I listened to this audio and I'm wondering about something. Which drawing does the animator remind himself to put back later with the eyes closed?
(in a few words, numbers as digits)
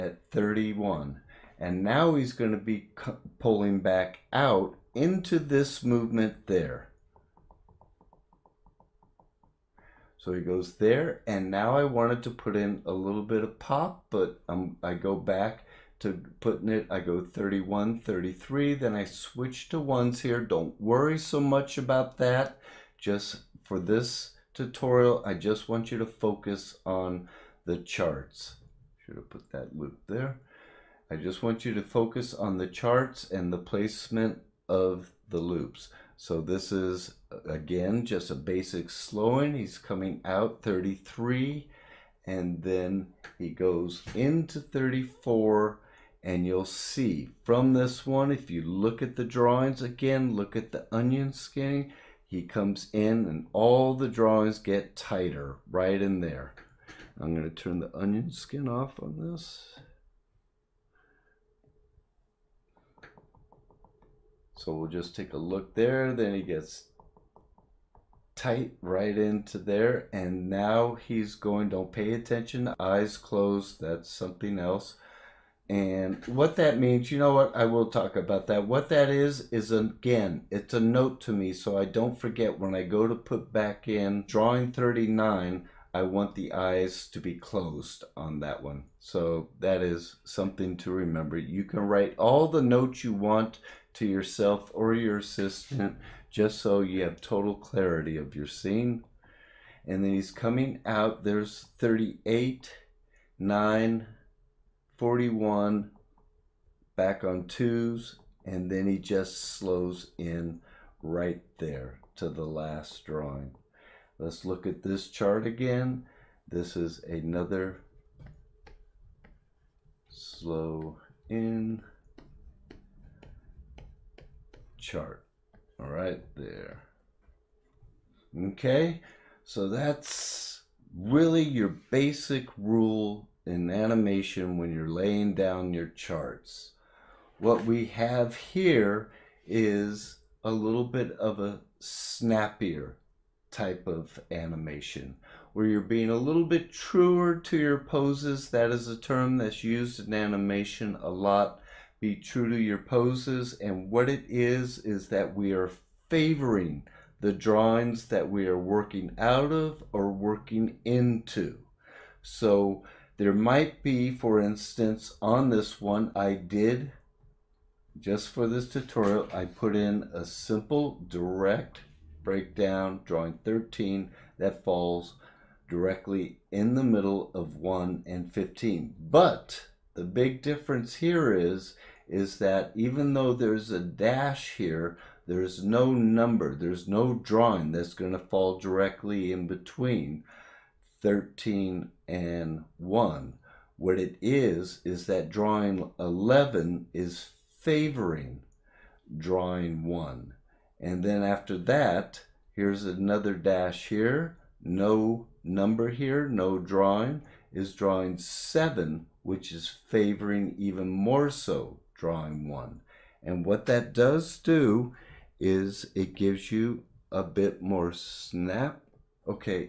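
39.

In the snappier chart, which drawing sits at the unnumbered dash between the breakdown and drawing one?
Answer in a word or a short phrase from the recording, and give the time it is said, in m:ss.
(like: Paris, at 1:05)
11, at 3:15.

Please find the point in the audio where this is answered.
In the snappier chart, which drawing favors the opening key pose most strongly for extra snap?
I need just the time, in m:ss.
3:27.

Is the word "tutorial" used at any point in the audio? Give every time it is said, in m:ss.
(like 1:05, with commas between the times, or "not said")
0:24, 2:48.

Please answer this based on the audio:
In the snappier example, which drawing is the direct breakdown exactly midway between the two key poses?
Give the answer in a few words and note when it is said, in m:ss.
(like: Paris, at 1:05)
13, at 2:53.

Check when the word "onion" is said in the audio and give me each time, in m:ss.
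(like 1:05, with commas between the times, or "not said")
0:50, 0:57.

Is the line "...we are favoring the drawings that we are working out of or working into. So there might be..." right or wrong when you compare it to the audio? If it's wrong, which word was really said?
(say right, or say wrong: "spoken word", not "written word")
right.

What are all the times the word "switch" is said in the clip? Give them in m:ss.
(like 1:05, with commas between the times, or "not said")
0:19.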